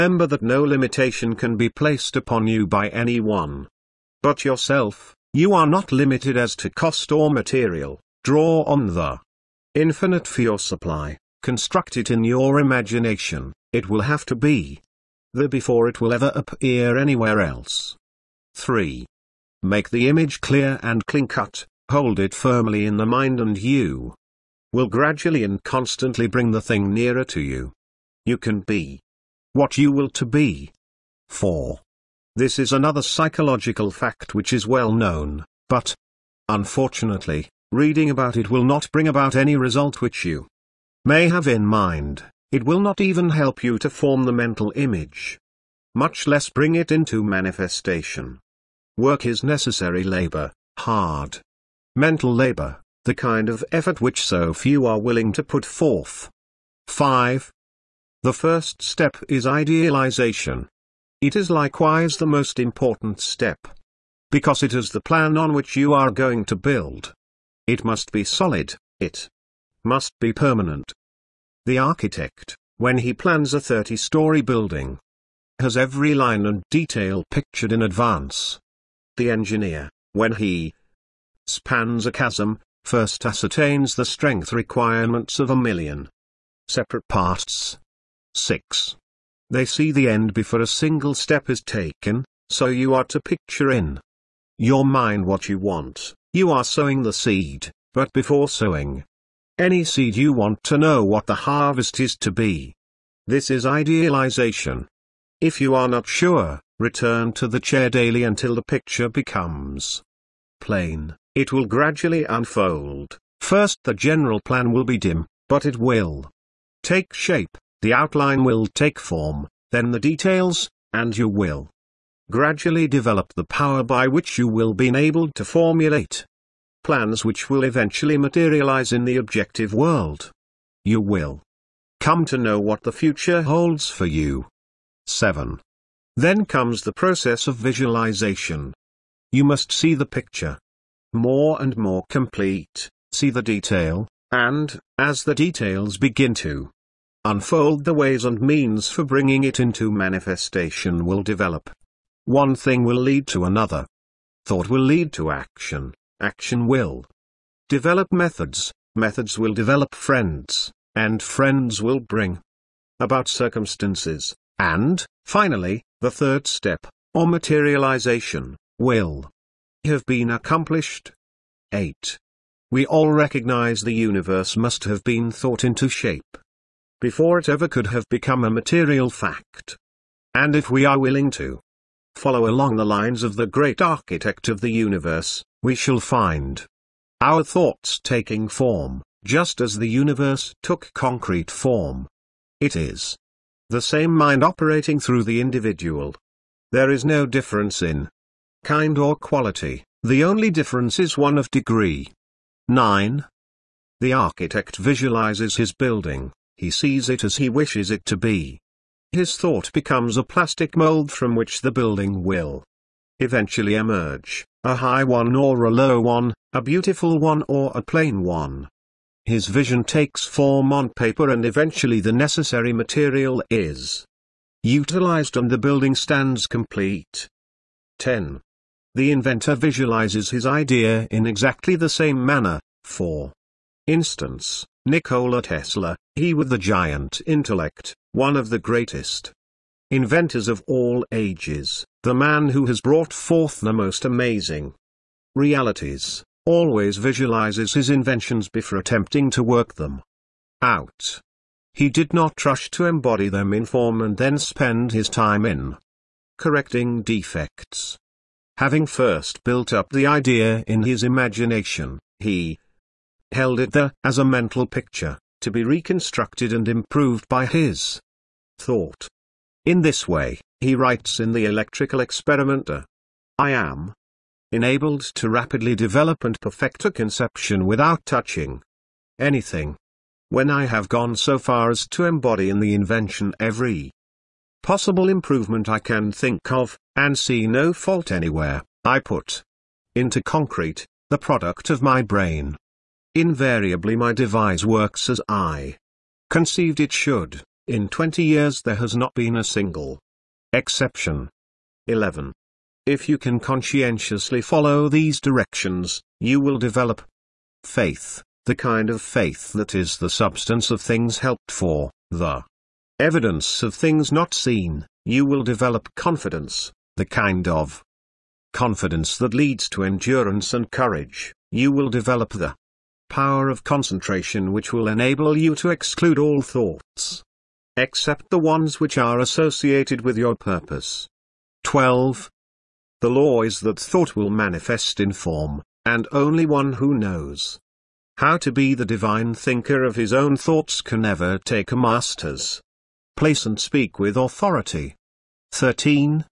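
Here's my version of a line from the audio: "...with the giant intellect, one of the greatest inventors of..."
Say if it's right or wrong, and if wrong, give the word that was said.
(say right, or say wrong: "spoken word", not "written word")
right.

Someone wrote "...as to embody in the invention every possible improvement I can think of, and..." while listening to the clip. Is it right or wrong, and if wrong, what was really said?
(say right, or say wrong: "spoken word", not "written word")
right.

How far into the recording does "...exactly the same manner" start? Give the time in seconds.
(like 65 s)
231 s.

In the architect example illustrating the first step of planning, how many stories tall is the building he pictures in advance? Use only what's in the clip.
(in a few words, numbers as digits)
30.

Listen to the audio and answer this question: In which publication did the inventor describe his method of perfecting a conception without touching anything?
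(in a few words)
The Electrical Experimenter.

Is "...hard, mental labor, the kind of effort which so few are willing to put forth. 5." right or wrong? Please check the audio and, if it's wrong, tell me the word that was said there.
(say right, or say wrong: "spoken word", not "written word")
right.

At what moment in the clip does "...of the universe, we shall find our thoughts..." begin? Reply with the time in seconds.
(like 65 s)
184 s.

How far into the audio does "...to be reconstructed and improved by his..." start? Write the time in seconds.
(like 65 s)
265 s.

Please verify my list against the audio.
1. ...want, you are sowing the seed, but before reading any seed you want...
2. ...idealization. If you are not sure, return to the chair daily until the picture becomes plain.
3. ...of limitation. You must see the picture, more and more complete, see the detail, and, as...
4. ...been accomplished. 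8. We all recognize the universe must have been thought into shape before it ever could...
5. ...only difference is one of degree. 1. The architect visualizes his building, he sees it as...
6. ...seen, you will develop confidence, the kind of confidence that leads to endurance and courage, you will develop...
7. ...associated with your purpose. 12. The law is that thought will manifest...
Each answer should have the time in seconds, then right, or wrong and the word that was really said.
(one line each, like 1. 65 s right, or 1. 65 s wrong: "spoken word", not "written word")
1. 95 s wrong: "sowing", not "reading"
2. 103 s right
3. 137 s wrong: "visualization", not "limitation"
4. 170 s right
5. 200 s wrong: "9", not "1"
6. 314 s right
7. 329 s right.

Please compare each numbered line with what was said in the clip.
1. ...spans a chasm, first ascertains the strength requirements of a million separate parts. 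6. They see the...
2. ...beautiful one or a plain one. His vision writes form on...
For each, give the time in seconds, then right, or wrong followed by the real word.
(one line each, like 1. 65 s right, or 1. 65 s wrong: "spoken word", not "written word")
1. 81 s right
2. 216 s wrong: "takes", not "writes".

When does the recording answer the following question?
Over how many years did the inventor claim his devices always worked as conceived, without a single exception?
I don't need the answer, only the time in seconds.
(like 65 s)
297 s.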